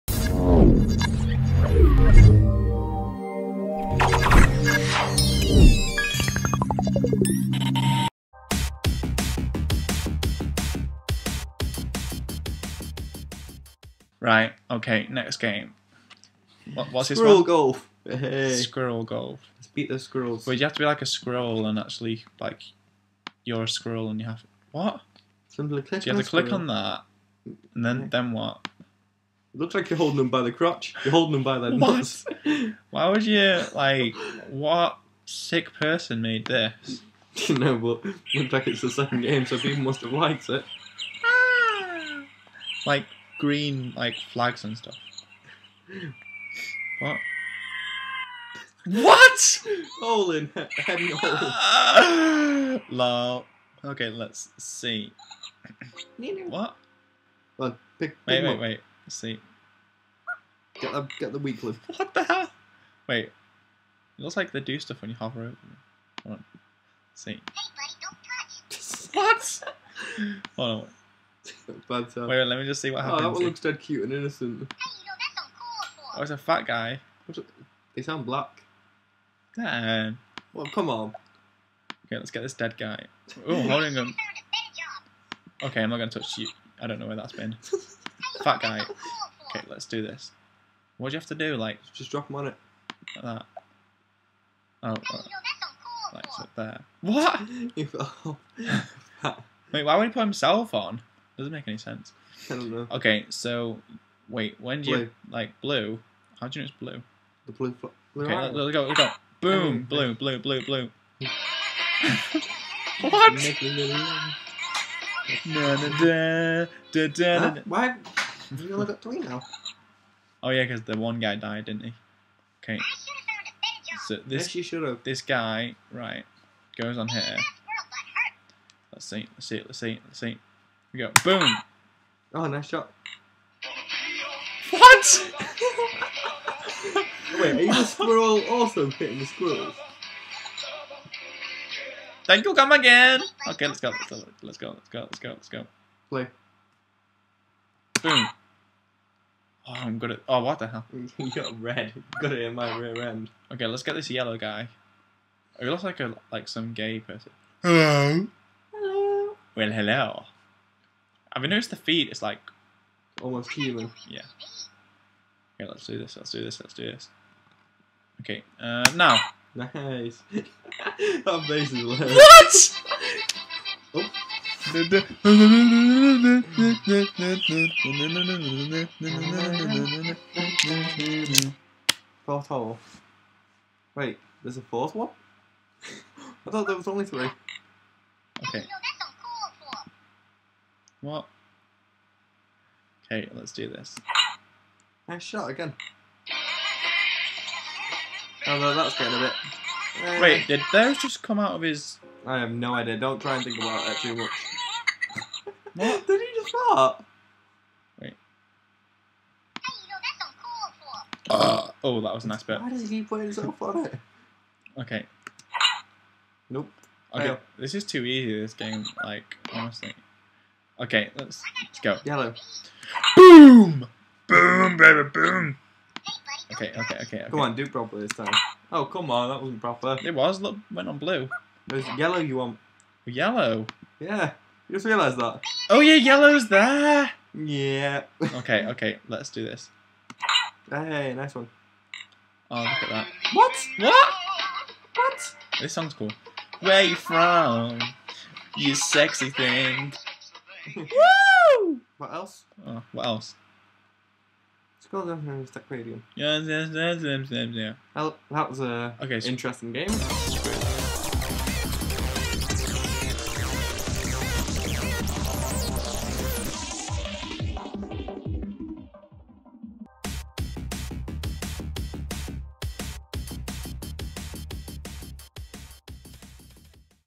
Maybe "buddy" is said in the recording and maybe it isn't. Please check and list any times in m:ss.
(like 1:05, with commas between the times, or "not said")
1:09.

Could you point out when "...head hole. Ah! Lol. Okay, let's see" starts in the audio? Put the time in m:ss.
0:50.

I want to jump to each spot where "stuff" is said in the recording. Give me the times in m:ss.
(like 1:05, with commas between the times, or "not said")
0:44, 1:04.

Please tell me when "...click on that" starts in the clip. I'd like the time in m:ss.
0:26.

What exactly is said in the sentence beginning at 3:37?
this is too easy, this game, like, honestly.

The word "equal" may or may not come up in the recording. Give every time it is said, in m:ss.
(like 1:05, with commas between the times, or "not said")
not said.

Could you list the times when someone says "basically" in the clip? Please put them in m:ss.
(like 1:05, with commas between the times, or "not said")
2:51.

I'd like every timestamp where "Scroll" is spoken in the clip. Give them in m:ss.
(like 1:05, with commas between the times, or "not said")
4:14.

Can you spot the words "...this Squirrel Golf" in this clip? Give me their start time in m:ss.
0:17.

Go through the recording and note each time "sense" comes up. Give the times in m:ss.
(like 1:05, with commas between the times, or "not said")
1:41.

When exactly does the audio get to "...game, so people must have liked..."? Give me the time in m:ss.
0:39.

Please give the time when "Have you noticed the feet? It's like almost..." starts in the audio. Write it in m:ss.
2:41.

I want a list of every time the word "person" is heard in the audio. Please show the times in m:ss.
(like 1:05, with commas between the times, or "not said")
0:35, 2:36.